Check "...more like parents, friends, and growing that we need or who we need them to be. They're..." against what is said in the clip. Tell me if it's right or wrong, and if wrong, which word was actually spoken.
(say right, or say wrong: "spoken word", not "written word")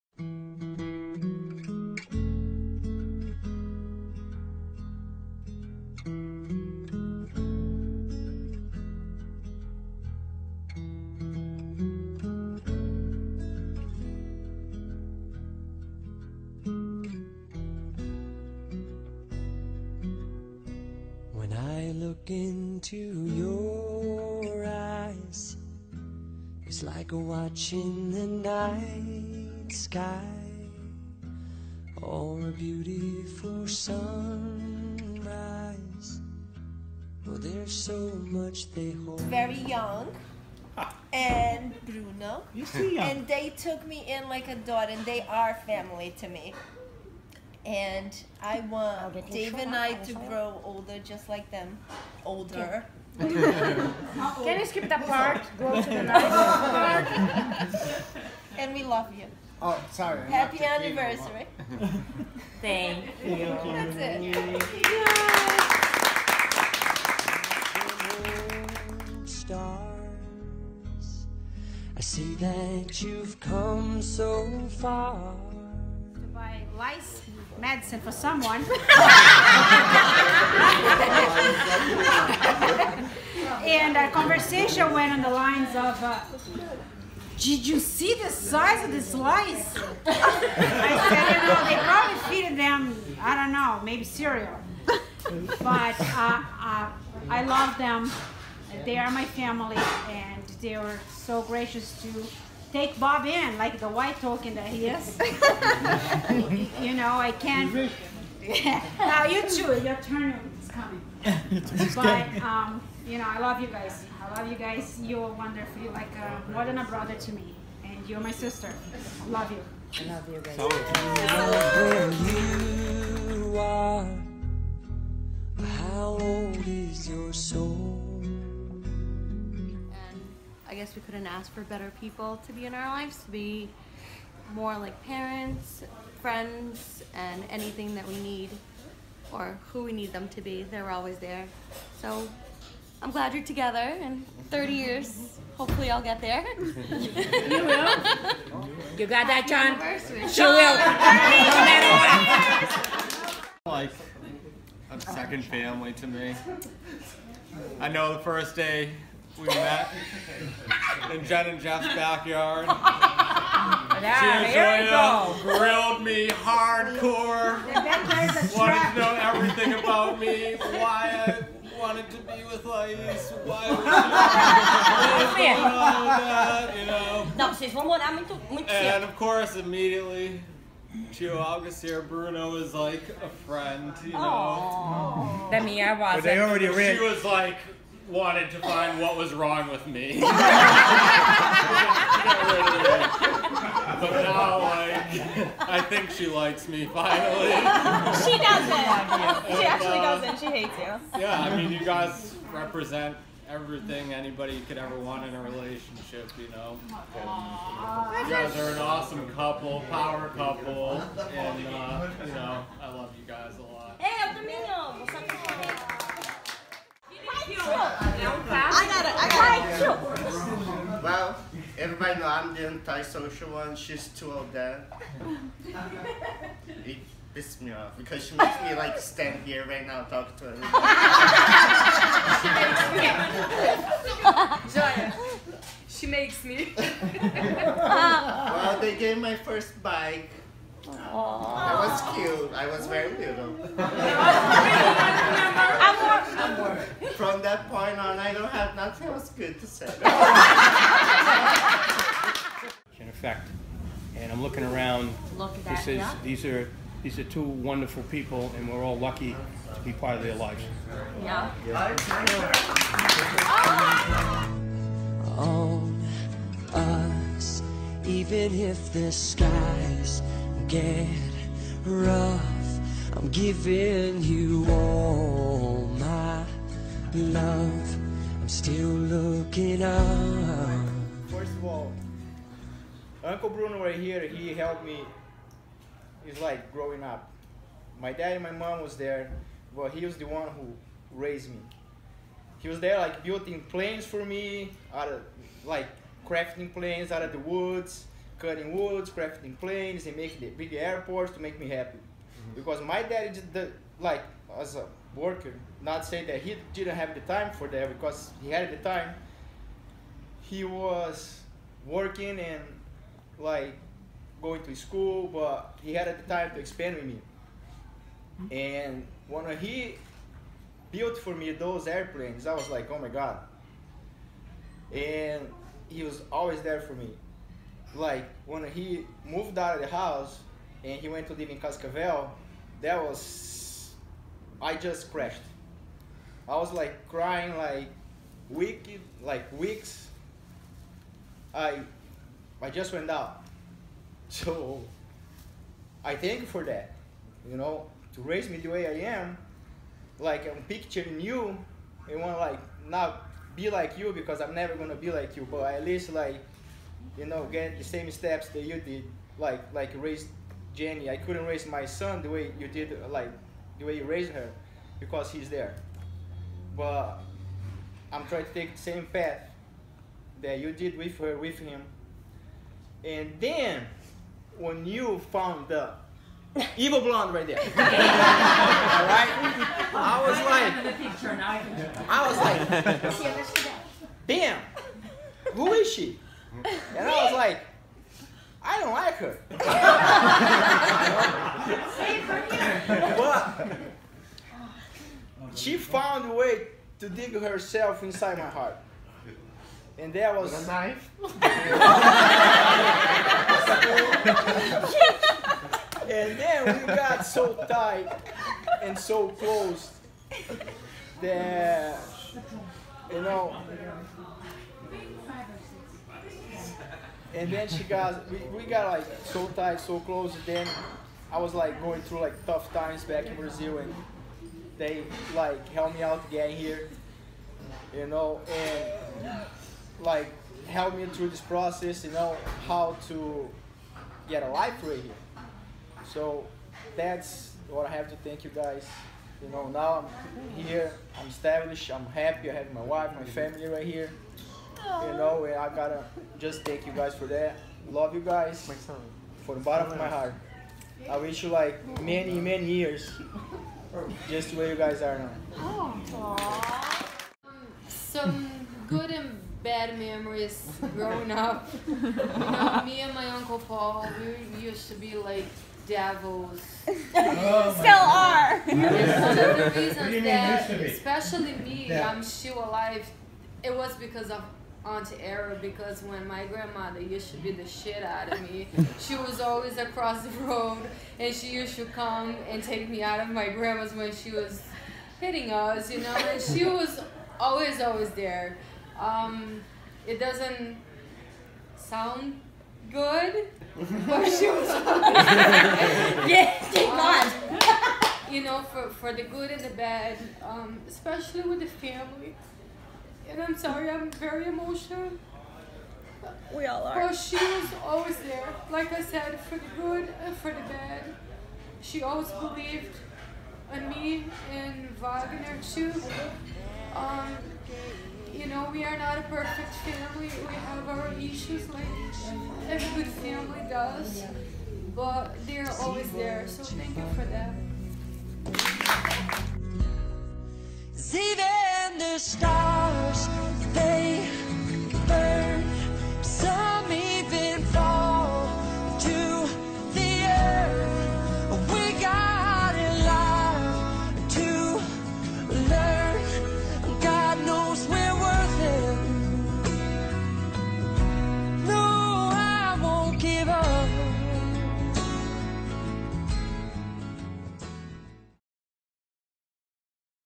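wrong: "anything", not "growing".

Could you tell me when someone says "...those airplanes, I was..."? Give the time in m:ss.
5:21.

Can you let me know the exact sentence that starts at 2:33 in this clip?
Like a second family to me.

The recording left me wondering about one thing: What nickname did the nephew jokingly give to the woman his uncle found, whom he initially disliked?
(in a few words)
evil blonde.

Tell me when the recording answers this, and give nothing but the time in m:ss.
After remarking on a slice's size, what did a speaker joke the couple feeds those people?
1:34.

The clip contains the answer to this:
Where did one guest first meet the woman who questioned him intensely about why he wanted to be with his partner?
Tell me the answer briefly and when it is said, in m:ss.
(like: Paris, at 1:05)
Jen and Jeff's backyard, at 2:41.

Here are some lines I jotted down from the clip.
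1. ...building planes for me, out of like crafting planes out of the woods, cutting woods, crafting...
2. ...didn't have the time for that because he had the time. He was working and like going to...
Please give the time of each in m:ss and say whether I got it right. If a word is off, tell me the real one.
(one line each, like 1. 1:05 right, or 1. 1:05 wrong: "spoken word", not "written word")
1. 4:53 right
2. 5:06 right.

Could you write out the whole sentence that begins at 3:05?
That me, I was But they already She was like, wanted to find what was wrong with me.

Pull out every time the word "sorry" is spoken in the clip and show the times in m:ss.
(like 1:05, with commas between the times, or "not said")
0:59, 8:23.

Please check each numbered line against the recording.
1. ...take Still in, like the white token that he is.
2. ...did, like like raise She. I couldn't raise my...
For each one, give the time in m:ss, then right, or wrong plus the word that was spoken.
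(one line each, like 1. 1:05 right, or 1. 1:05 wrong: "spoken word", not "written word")
1. 1:42 wrong: "Bob", not "Still"
2. 5:58 wrong: "Jenny", not "She".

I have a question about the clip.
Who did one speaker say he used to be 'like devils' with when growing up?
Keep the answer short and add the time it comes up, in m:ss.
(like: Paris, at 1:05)
Uncle Paul, at 7:43.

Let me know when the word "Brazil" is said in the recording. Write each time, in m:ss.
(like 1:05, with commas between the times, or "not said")
7:03.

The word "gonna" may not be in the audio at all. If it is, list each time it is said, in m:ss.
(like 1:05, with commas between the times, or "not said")
5:54.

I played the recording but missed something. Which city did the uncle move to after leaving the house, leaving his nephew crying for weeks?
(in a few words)
Cascavel.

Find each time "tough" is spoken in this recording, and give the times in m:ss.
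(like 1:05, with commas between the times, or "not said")
7:02.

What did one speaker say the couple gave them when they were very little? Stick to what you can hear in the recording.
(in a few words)
first bike.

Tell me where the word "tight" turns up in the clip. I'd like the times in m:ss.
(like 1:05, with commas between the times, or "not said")
6:47, 6:59.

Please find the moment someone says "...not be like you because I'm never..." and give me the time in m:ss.
5:52.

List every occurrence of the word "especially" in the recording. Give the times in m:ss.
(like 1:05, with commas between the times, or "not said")
7:50, 8:20.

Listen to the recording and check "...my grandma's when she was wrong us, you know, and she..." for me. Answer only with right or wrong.
wrong.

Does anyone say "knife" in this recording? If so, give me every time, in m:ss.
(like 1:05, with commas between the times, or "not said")
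6:40.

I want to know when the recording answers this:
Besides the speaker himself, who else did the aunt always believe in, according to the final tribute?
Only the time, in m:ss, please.
8:35.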